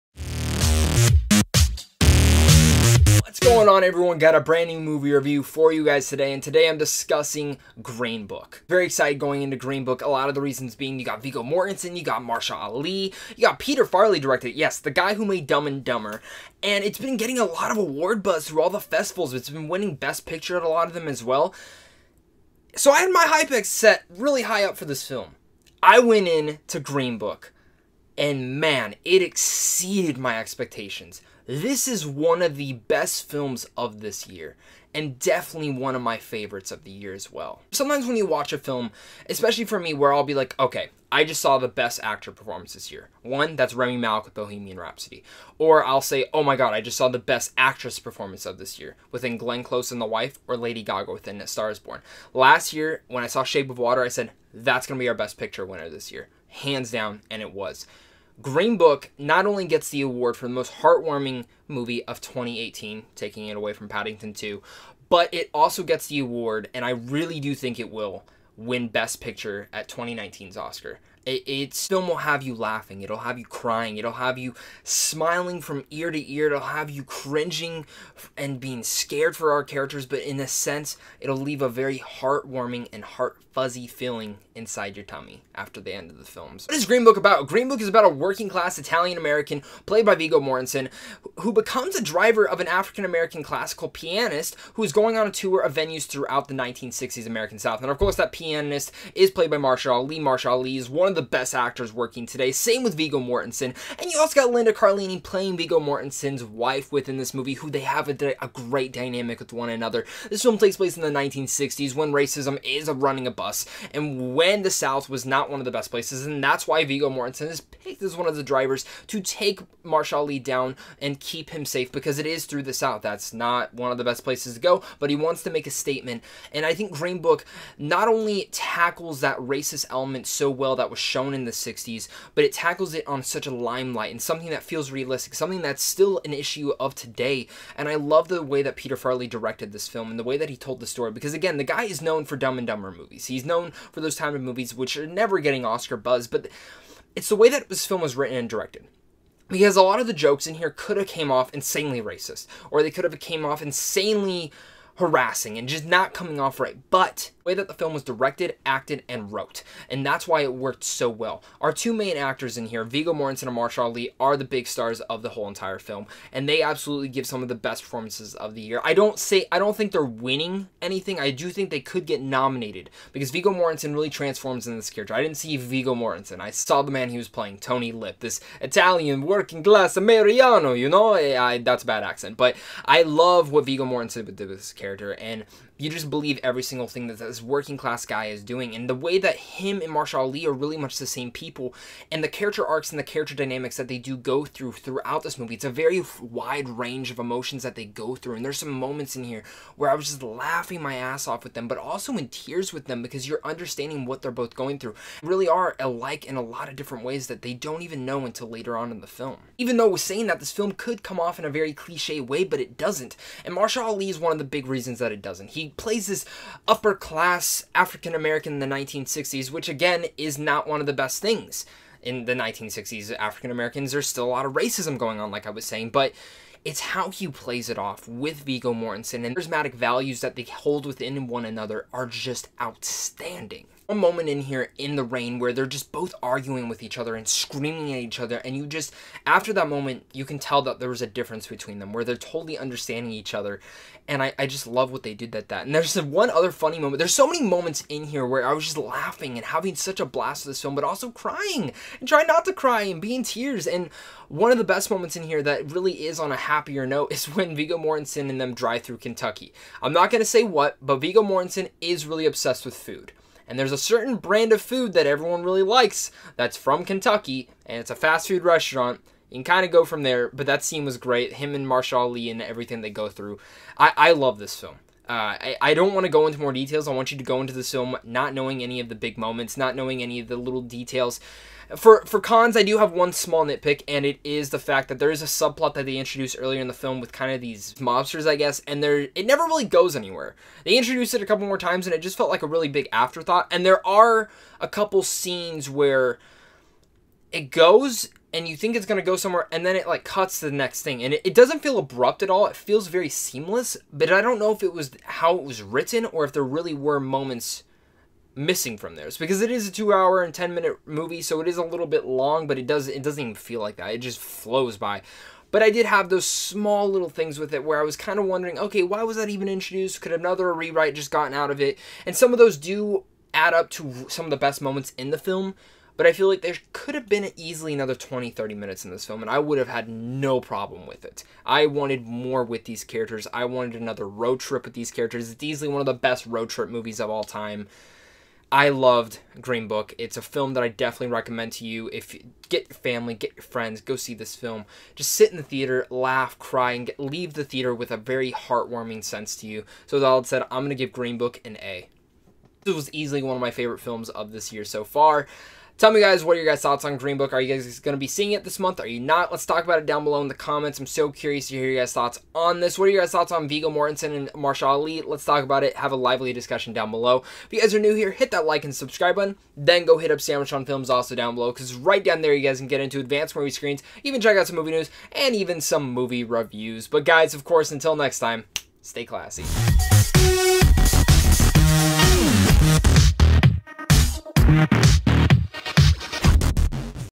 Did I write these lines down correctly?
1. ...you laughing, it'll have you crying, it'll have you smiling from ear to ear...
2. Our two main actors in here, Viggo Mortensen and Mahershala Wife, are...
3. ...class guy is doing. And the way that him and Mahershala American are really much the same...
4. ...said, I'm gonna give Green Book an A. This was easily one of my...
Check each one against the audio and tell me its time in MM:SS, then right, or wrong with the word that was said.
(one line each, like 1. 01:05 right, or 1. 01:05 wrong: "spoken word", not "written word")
1. 01:12 right
2. 02:41 wrong: "Ali", not "Wife"
3. 03:07 wrong: "Ali", not "American"
4. 05:50 right.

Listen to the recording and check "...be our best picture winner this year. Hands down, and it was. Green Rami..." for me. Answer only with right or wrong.
wrong.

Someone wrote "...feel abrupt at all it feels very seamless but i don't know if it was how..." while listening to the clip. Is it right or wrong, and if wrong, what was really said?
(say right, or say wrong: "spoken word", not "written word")
right.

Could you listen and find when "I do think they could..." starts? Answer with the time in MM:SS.
02:51.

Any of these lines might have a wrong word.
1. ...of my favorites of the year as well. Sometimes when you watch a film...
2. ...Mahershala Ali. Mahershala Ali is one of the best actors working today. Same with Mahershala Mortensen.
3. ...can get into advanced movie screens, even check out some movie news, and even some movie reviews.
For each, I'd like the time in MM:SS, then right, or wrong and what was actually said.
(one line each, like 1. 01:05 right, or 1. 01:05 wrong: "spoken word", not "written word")
1. 00:35 right
2. 01:39 wrong: "Viggo", not "Mahershala"
3. 06:12 right.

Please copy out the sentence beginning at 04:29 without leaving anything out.
You can kind of go from there, but that scene was great.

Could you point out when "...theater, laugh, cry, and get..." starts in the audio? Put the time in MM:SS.
05:45.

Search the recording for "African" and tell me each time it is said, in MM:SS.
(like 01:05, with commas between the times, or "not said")
01:32, 03:37, 03:43.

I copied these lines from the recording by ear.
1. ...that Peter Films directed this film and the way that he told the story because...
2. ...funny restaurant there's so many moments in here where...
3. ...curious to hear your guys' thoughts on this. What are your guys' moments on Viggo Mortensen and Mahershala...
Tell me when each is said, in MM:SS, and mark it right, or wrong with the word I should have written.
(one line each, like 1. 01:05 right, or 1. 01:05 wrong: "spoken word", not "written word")
1. 02:18 wrong: "Farrelly", not "Films"
2. 04:06 wrong: "moment", not "restaurant"
3. 06:01 wrong: "thoughts", not "moments".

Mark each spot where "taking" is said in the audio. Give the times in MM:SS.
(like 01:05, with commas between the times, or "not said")
01:03.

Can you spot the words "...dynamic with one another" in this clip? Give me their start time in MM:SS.
01:48.